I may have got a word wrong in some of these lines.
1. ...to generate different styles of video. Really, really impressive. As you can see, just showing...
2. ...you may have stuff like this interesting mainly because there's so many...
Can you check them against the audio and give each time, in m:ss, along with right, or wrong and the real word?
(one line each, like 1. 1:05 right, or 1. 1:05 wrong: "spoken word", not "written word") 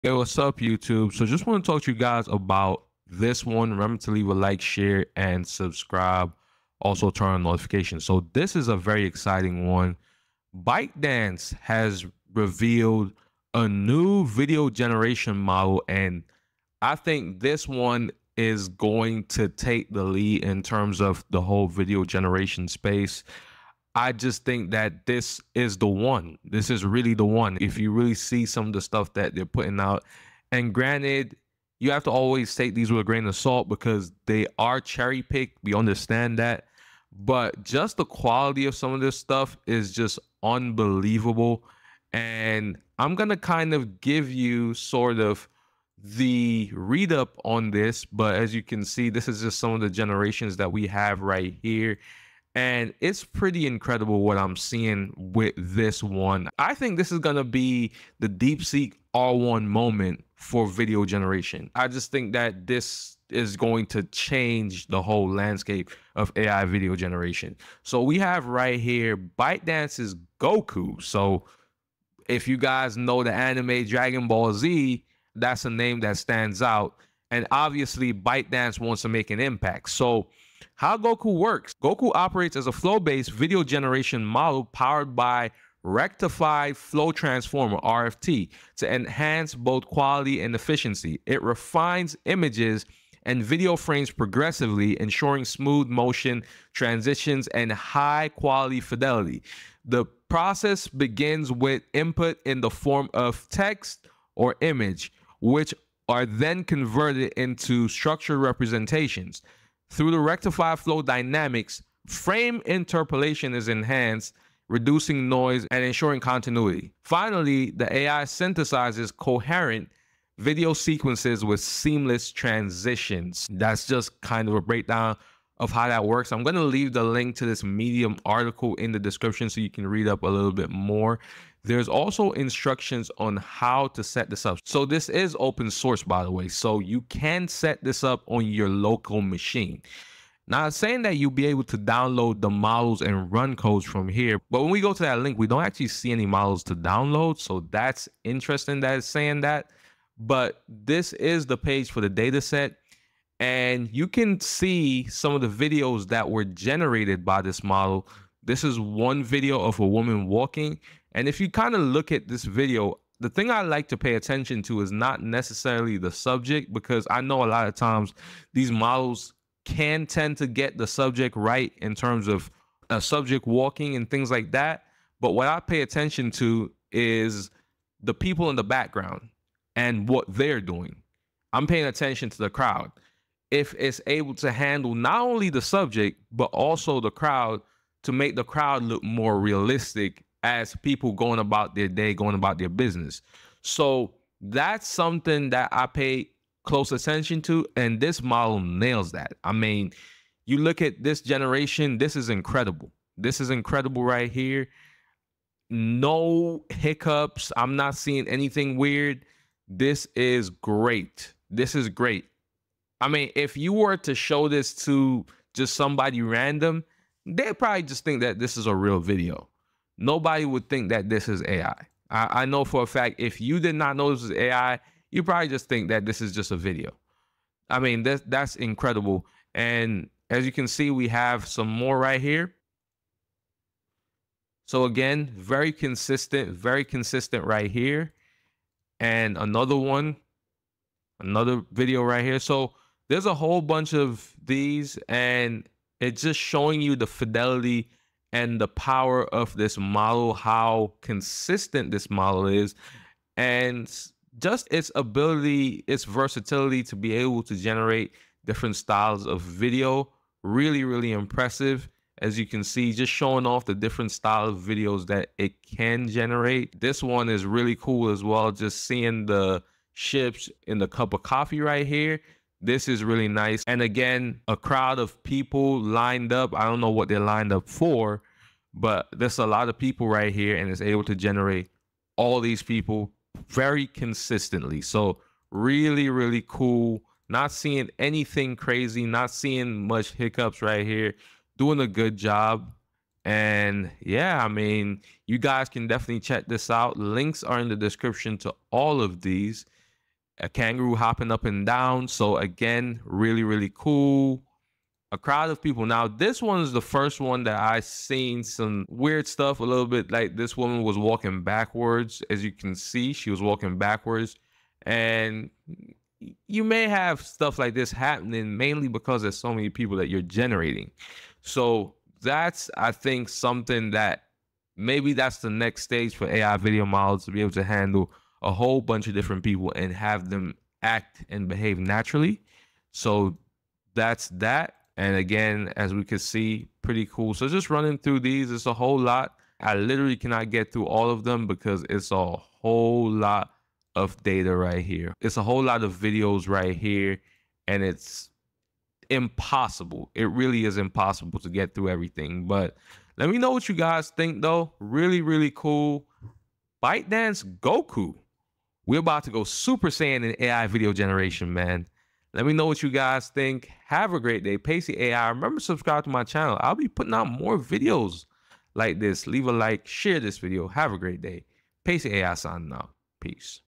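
1. 4:17 right
2. 5:16 wrong: "happening", not "interesting".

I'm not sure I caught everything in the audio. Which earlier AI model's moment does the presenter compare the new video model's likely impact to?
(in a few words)
DeepSeek R1.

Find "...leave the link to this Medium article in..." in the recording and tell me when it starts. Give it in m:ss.
2:06.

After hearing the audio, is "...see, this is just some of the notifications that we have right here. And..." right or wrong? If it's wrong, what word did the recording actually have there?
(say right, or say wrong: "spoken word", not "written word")
wrong: "generations", not "notifications".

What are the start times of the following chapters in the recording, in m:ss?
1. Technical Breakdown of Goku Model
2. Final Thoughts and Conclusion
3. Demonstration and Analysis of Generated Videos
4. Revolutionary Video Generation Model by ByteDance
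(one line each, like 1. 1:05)
1. 1:19
2. 5:52
3. 2:33
4. 0:10.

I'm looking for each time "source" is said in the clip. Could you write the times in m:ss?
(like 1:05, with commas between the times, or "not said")
2:15.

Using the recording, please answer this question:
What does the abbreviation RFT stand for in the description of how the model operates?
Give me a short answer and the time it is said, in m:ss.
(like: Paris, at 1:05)
Rectified Flow Transformer, at 1:25.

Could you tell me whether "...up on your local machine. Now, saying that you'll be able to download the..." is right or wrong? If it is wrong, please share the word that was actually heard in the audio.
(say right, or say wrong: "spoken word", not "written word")
right.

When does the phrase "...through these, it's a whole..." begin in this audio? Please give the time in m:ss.
5:37.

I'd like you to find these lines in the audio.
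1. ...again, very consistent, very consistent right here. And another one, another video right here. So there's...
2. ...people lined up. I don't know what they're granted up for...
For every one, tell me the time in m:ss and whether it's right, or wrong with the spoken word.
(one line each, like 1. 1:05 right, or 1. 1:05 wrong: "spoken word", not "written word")
1. 3:54 right
2. 4:35 wrong: "lined", not "granted".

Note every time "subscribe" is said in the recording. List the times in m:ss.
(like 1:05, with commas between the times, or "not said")
0:05, 6:05.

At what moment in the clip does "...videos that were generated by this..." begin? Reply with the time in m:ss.
2:35.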